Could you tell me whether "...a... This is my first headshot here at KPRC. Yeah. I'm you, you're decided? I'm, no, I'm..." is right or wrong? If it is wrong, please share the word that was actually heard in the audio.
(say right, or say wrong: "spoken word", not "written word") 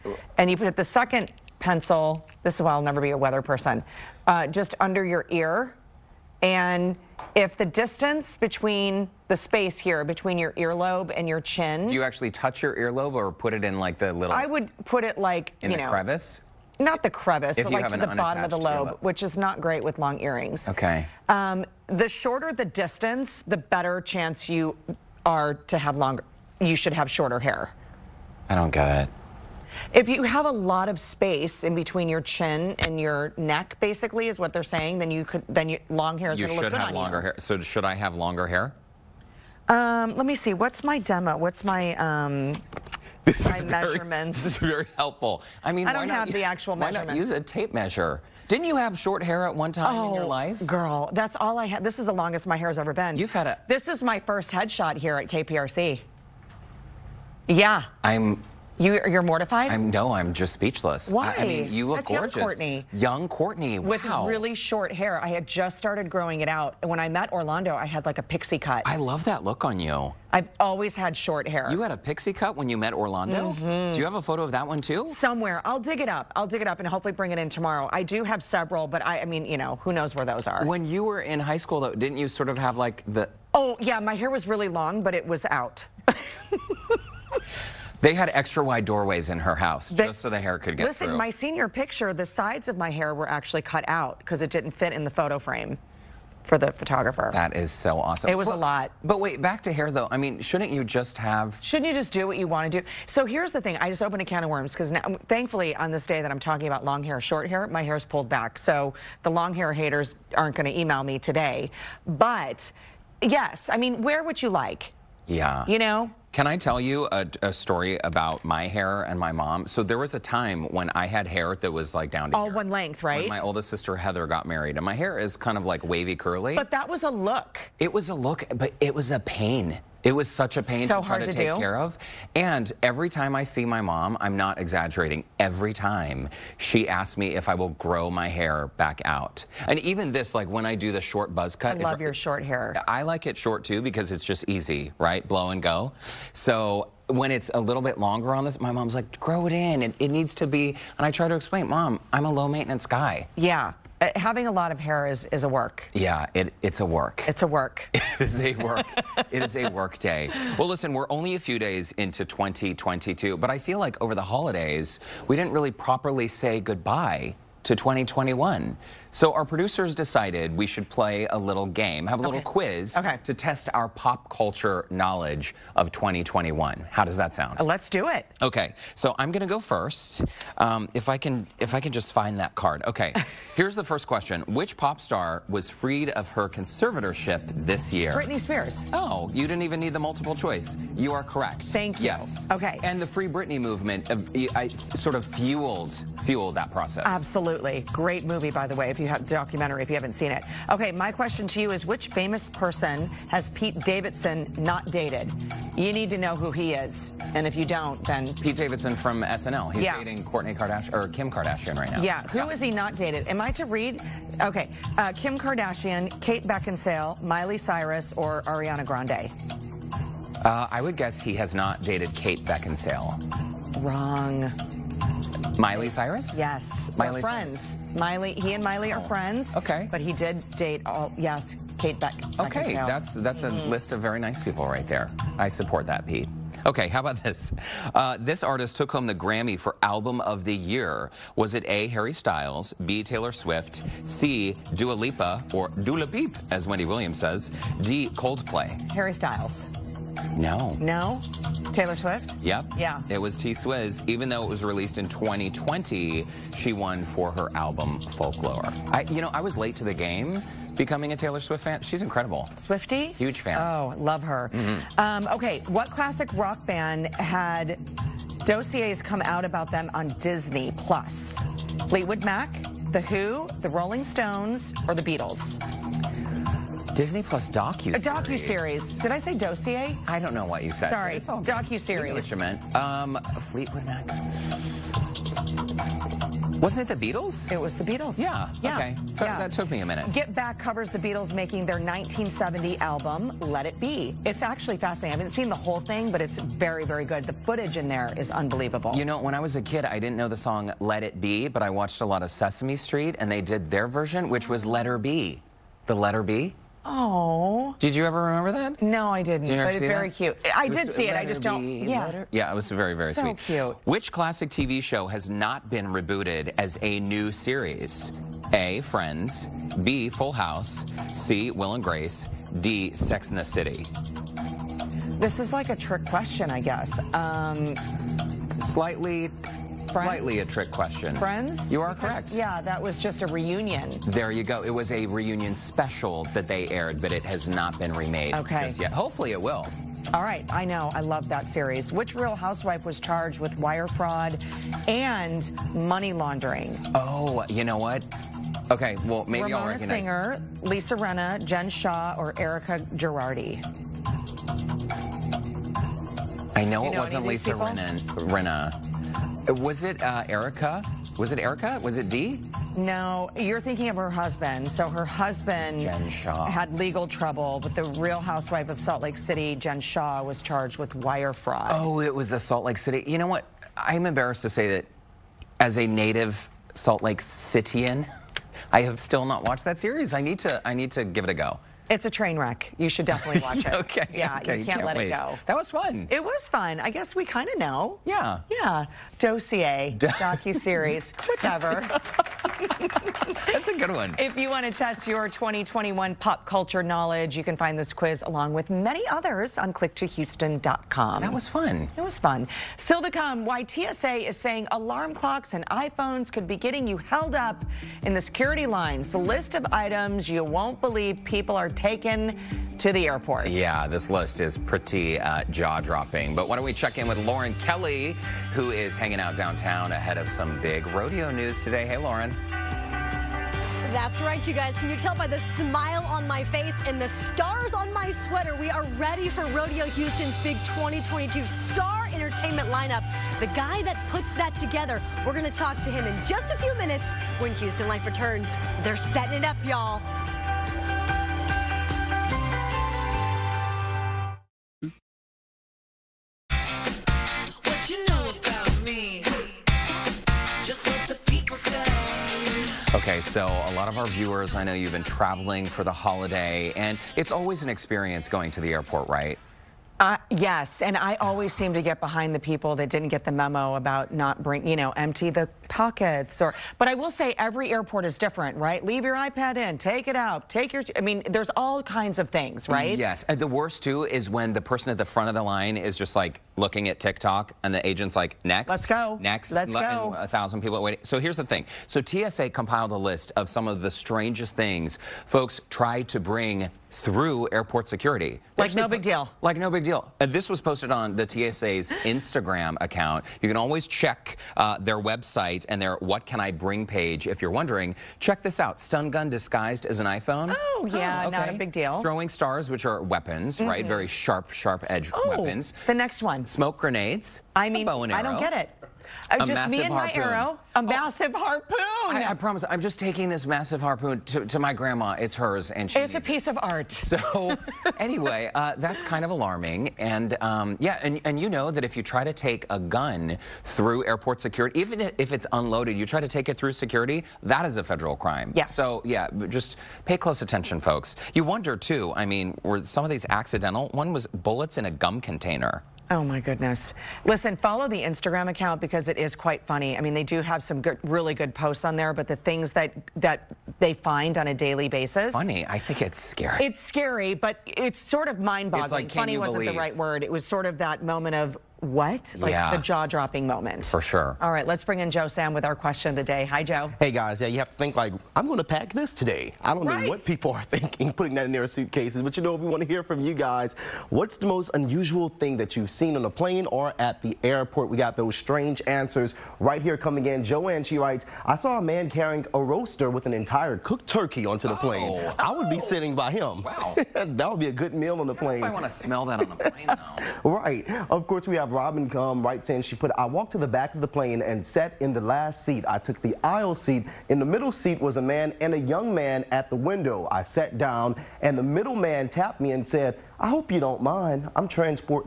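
wrong: "mortified", not "decided".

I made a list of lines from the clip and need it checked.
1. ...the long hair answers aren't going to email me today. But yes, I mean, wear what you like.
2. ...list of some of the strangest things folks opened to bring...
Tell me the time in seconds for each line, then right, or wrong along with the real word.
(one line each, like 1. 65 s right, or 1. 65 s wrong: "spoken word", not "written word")
1. 109 s wrong: "haters", not "answers"
2. 482 s wrong: "tried", not "opened".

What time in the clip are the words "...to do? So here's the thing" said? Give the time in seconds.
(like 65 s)
102 s.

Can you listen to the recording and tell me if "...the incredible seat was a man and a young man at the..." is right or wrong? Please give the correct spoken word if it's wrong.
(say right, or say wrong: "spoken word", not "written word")
wrong: "middle", not "incredible".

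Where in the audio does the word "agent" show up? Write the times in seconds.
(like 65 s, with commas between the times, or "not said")
477 s.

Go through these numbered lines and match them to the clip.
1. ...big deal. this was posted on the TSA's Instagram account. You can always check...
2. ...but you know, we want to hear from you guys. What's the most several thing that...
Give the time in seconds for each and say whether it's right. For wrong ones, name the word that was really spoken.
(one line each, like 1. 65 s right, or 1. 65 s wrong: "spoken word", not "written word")
1. 489 s right
2. 562 s wrong: "unusual", not "several".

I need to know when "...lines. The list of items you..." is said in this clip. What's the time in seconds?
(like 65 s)
408 s.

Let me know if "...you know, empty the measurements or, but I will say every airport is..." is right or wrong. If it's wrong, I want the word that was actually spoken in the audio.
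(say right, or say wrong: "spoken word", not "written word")
wrong: "pockets", not "measurements".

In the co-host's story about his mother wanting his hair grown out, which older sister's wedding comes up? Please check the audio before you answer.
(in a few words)
Heather.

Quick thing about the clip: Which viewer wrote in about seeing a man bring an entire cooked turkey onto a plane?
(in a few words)
Joanne.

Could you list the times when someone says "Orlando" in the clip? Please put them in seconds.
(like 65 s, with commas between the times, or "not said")
67 s, 72 s.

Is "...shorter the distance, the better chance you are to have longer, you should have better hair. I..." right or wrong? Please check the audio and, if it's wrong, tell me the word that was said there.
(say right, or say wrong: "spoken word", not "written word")
wrong: "shorter", not "better".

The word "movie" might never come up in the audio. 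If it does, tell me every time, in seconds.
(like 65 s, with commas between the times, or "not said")
198 s.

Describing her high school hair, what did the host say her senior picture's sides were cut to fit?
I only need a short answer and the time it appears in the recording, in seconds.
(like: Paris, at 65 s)
photo frame, at 95 s.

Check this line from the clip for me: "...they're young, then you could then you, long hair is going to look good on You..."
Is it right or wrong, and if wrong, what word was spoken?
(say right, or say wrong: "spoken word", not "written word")
wrong: "saying", not "young".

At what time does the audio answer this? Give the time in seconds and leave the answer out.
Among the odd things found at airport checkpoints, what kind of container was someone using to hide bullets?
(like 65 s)
534 s.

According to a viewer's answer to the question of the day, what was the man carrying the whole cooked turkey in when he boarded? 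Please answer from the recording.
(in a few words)
a roaster.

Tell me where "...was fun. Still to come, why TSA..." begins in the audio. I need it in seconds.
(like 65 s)
402 s.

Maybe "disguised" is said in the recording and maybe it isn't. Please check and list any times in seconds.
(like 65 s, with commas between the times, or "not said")
499 s.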